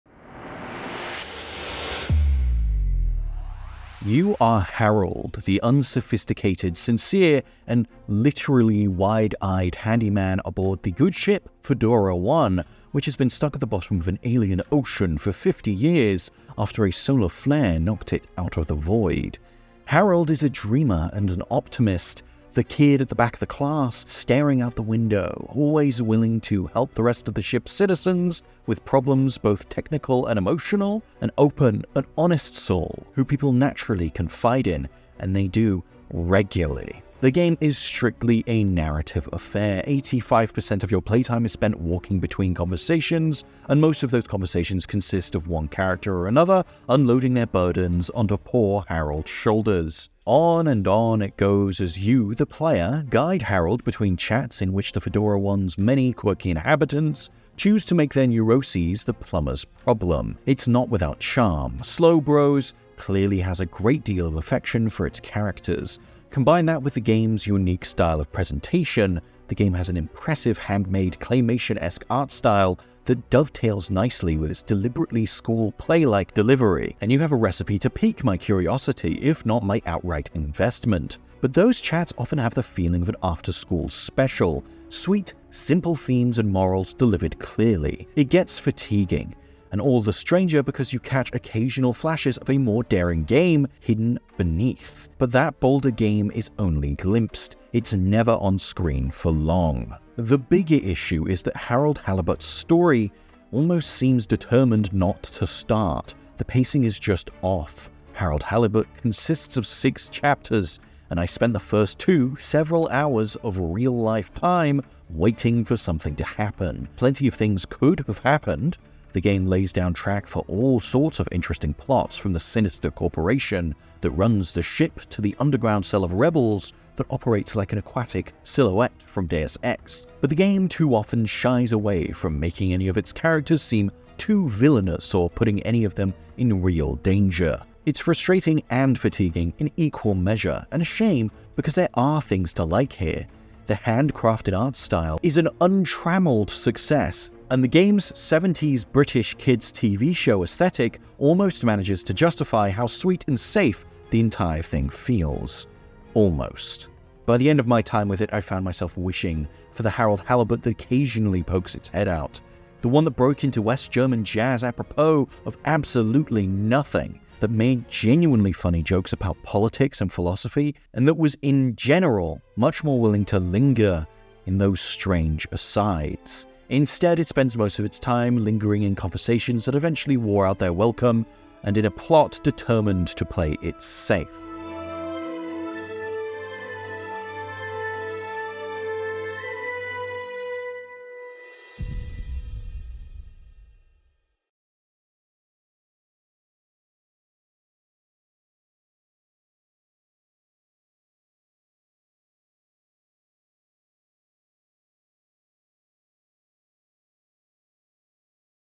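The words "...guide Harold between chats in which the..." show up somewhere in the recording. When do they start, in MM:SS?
00:53.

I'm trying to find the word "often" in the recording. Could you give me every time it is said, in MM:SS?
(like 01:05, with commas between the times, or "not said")
01:22, 02:10.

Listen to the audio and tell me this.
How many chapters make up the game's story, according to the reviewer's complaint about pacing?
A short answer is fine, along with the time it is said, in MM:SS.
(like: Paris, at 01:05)
6, at 01:49.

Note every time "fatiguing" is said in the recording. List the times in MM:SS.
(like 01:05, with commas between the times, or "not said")
01:28, 02:18.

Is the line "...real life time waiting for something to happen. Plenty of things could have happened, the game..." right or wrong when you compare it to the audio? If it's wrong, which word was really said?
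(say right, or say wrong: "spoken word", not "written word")
right.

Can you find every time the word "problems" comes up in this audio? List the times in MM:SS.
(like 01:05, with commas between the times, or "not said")
00:28, 00:59.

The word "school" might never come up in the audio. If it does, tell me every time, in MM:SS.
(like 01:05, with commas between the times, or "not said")
01:15, 01:23.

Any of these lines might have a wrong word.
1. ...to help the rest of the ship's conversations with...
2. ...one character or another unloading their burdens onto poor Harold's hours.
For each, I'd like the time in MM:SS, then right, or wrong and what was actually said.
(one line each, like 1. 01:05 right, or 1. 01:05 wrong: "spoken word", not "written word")
1. 00:26 wrong: "citizens", not "conversations"
2. 00:45 wrong: "shoulders", not "hours".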